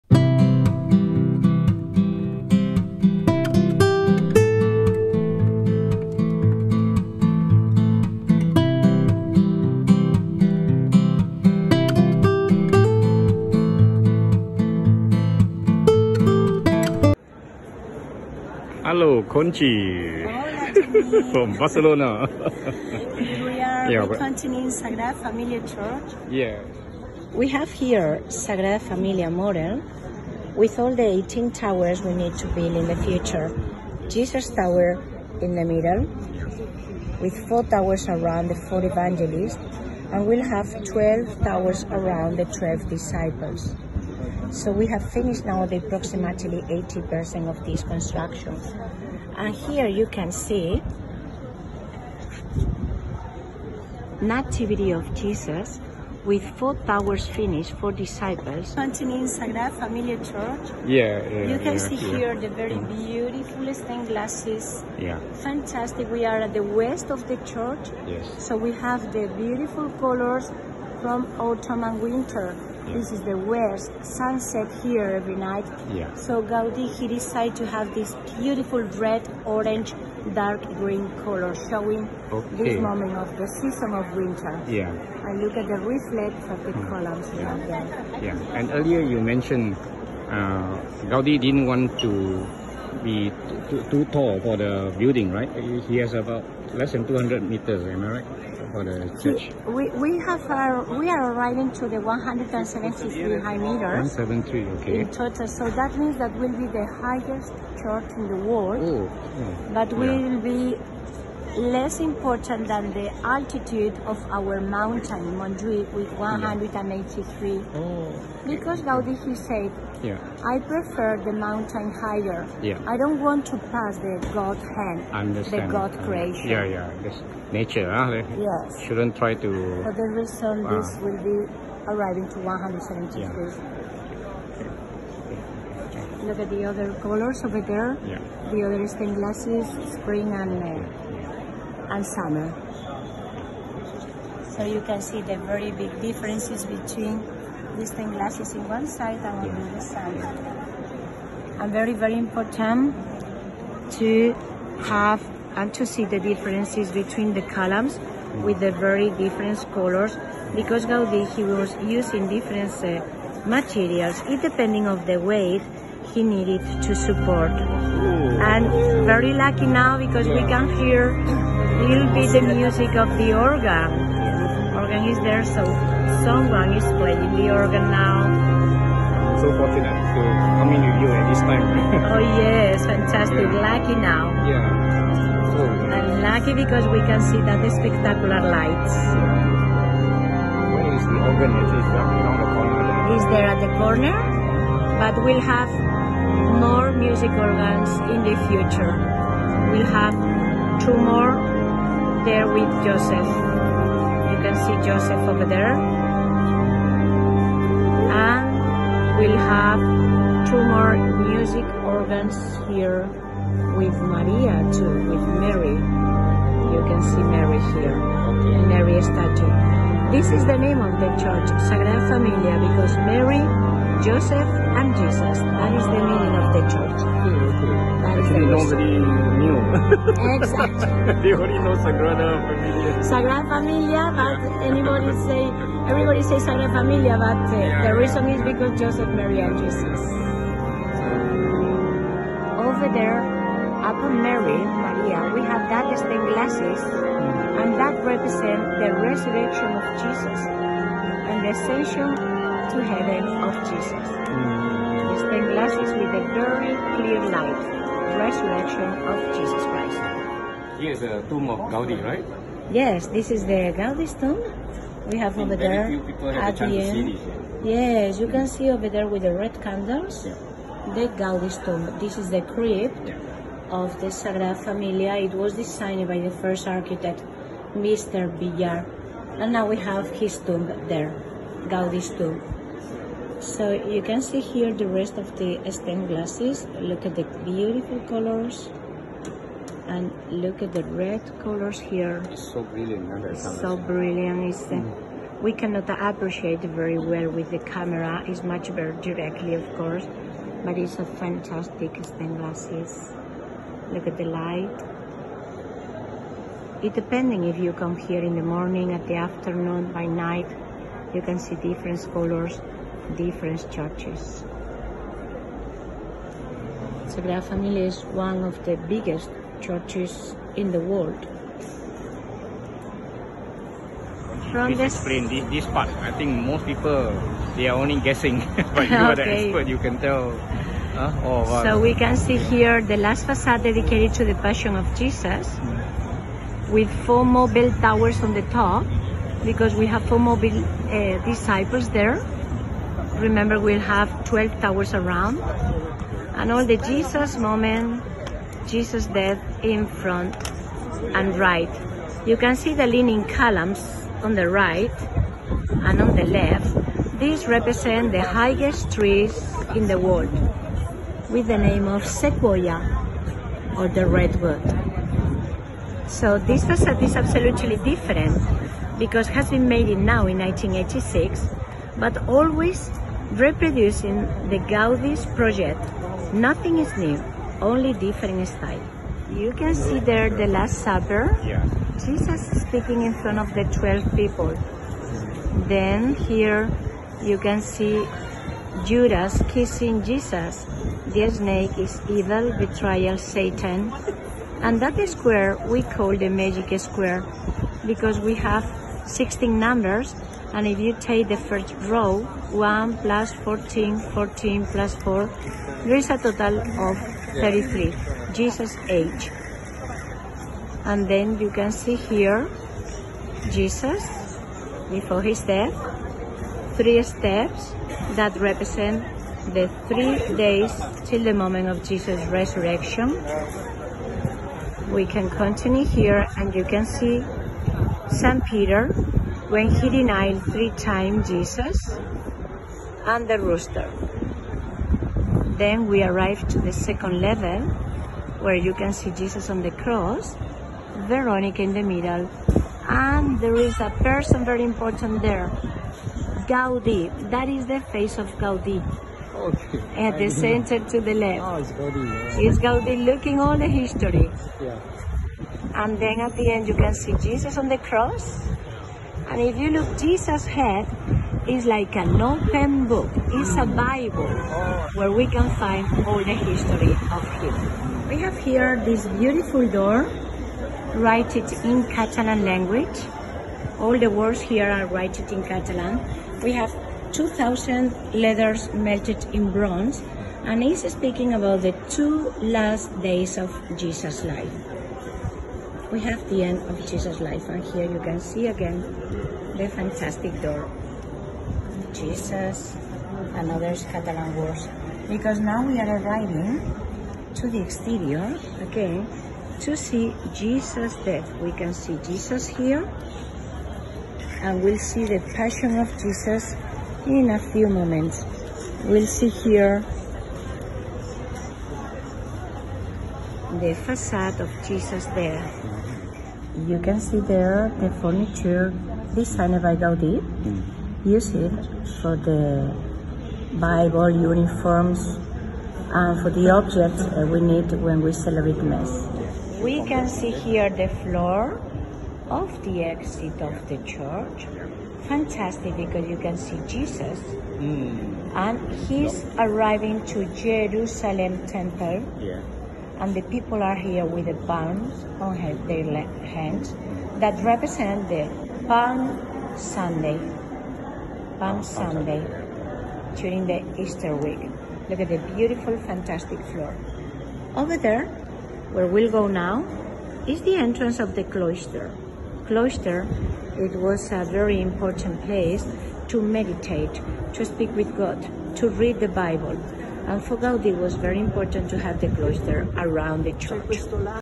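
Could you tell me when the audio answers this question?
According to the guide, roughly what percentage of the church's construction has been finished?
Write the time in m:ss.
0:46.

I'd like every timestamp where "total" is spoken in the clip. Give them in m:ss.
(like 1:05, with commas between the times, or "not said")
1:45, 6:46.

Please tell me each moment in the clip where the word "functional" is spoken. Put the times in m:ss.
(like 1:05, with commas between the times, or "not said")
not said.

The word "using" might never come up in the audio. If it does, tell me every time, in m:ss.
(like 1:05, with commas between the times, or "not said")
2:41.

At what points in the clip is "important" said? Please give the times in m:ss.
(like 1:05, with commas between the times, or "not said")
1:51, 2:32, 7:24, 9:24, 9:31.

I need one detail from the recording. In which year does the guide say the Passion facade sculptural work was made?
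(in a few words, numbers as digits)
1986.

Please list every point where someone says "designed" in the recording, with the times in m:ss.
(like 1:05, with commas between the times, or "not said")
4:35, 8:39.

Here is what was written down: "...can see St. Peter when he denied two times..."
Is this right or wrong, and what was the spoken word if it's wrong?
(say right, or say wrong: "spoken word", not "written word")
wrong: "three", not "two".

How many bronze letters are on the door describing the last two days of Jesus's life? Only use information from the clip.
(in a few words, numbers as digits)
2,000.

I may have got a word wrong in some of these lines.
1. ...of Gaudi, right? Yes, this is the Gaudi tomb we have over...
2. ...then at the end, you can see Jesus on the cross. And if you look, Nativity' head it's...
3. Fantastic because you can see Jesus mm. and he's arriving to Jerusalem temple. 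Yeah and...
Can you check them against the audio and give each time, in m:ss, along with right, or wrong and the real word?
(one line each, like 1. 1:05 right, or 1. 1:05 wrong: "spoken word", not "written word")
1. 4:21 right
2. 7:35 wrong: "Jesus", not "Nativity"
3. 8:55 right.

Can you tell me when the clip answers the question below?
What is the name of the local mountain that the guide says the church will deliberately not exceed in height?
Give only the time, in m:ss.
1:55.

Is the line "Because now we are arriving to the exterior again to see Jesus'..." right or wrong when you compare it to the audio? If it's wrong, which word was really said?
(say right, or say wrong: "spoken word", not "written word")
right.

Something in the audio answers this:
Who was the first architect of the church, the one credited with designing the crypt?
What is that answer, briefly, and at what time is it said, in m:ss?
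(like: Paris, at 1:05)
Mr. Villar, at 4:37.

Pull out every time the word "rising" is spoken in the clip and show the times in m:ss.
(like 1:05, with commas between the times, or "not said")
not said.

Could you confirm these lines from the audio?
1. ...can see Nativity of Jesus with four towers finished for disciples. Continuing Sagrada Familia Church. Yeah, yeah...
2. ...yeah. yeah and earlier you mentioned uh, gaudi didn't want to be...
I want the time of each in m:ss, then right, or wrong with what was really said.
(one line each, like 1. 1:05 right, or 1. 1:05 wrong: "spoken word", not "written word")
1. 0:50 right
2. 1:27 right.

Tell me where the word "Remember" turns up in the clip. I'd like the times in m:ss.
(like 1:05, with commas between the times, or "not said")
5:43.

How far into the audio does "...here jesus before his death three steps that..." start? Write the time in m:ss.
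6:51.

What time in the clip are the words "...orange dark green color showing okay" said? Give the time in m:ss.
1:19.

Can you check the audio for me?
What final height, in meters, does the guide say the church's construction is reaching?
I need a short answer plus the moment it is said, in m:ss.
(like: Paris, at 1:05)
173 meters, at 1:41.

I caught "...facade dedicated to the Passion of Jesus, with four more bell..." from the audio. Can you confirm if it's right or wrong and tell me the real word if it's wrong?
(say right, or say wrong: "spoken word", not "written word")
right.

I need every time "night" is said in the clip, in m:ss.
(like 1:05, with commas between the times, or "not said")
1:15, 5:10.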